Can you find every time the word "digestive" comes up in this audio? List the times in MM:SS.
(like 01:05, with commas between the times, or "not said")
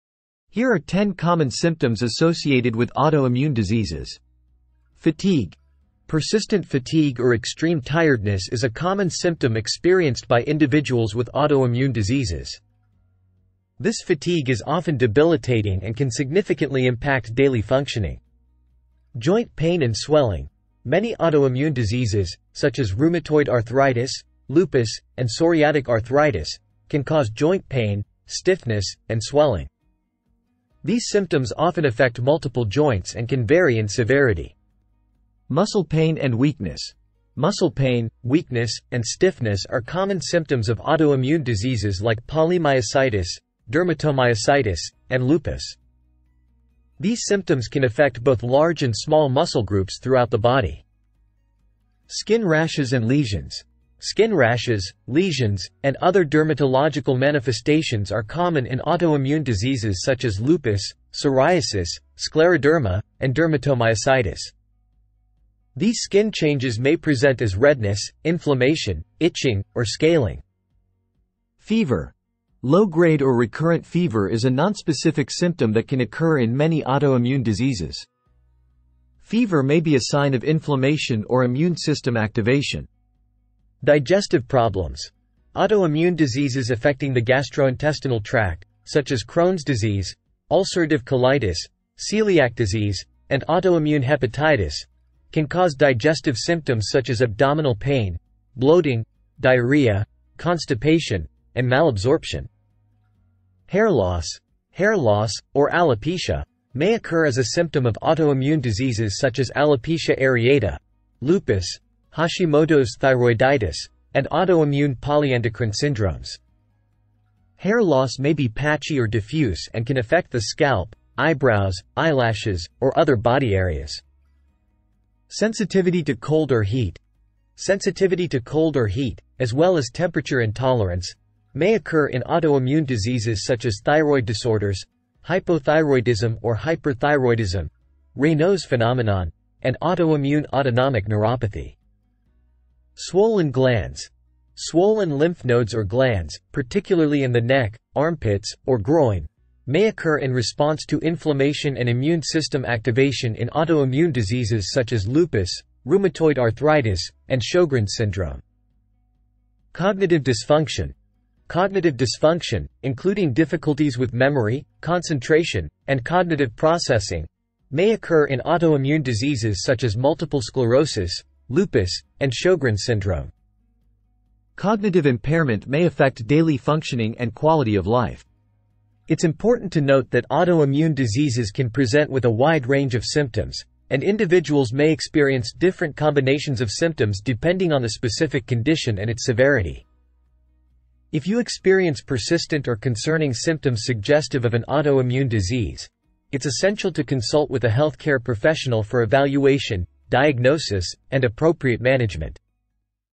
01:23, 01:35.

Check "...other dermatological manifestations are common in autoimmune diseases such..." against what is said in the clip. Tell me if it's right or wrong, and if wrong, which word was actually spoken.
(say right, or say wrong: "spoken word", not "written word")
right.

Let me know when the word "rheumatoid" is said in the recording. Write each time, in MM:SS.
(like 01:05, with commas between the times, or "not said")
00:22, 02:35.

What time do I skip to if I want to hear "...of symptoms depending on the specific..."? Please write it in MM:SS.
03:06.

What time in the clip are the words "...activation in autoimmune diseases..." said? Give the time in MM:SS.
02:32.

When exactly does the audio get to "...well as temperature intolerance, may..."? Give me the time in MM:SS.
02:09.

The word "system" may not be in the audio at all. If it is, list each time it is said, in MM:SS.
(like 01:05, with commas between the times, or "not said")
01:21, 02:32.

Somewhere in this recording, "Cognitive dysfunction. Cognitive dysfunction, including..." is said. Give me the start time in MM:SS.
02:39.